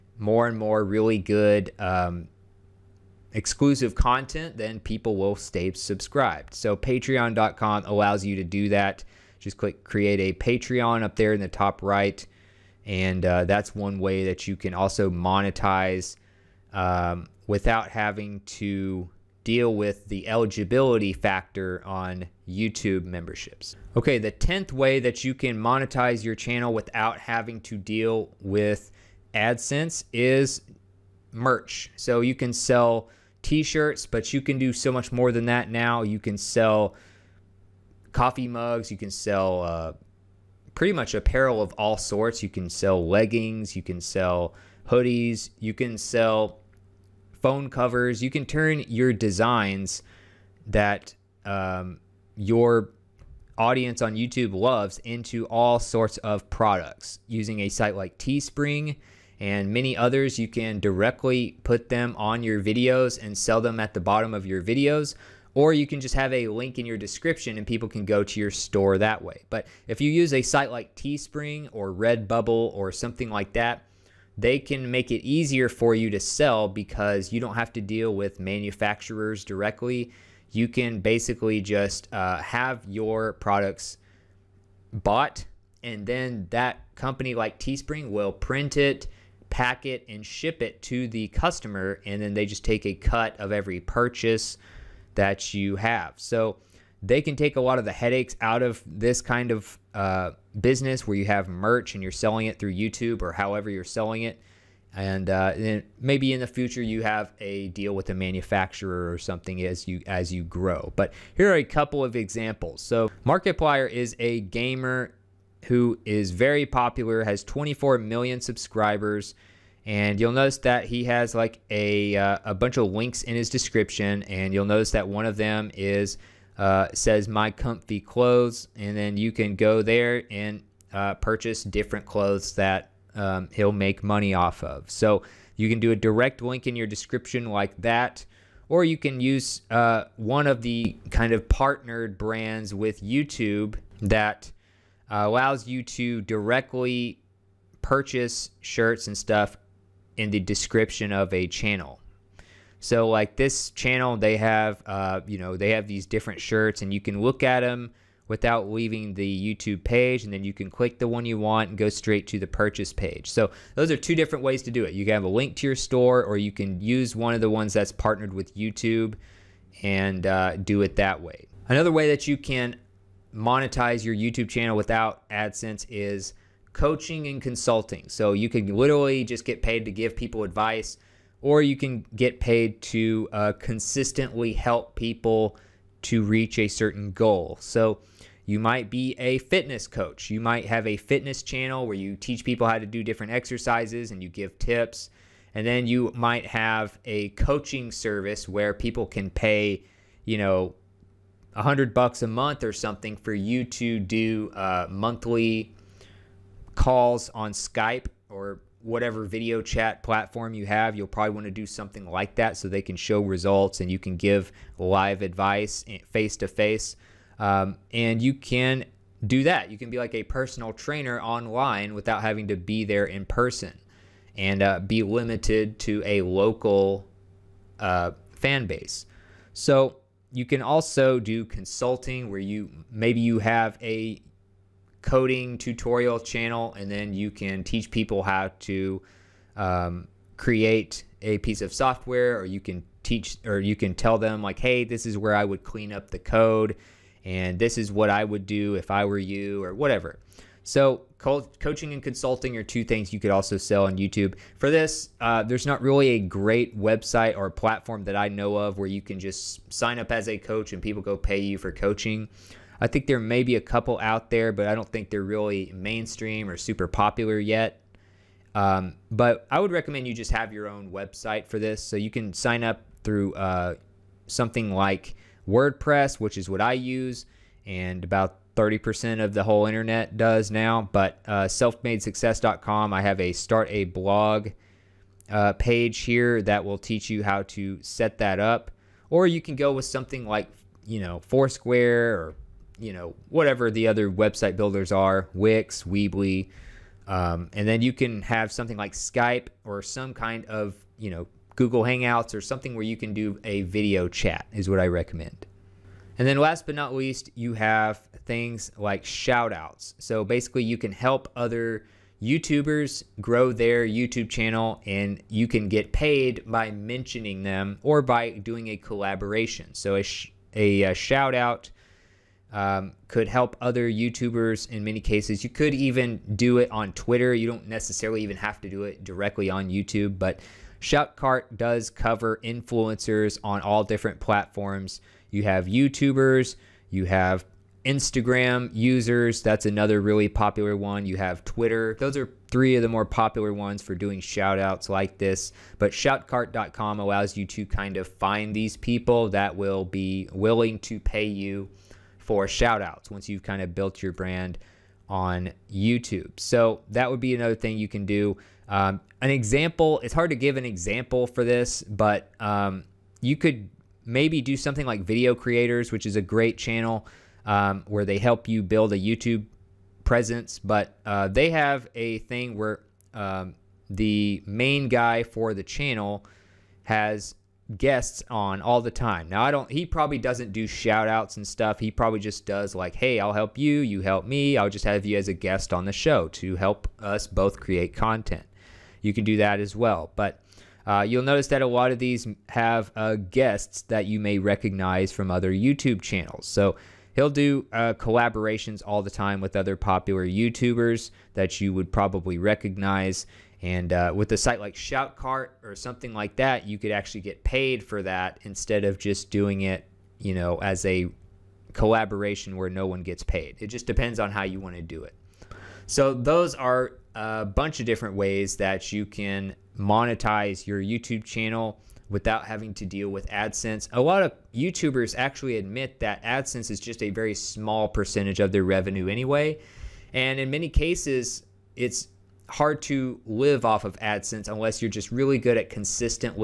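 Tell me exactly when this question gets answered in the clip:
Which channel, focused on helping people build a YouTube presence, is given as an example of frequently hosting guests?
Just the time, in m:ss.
6:05.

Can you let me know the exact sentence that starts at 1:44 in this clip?
And, uh, and then maybe in the future you have a deal with a manufacturer or something as you as you grow.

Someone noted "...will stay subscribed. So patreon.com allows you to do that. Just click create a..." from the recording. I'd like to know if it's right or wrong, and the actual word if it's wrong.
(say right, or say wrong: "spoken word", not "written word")
right.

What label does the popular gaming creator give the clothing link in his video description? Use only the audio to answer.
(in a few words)
my comfy clothes.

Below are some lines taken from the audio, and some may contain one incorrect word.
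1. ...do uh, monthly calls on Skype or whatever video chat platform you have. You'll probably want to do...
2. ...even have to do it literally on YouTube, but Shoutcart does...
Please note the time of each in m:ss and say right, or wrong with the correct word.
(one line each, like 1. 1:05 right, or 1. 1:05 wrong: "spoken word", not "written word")
1. 3:23 right
2. 5:28 wrong: "directly", not "literally".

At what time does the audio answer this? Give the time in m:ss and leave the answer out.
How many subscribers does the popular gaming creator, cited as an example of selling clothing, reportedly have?
1:57.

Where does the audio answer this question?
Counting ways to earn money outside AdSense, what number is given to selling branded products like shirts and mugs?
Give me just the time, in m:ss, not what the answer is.
0:24.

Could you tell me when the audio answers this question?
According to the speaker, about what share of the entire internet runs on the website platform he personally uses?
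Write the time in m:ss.
4:38.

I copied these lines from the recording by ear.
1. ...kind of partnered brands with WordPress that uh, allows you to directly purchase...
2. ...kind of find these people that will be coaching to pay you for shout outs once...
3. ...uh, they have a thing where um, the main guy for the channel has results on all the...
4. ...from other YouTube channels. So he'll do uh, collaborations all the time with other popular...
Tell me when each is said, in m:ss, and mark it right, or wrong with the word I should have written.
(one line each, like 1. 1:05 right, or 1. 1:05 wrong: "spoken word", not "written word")
1. 2:21 wrong: "YouTube", not "WordPress"
2. 5:47 wrong: "willing", not "coaching"
3. 6:11 wrong: "guests", not "results"
4. 6:35 right.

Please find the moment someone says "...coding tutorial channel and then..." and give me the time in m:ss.
3:55.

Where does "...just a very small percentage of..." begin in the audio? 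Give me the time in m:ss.
7:06.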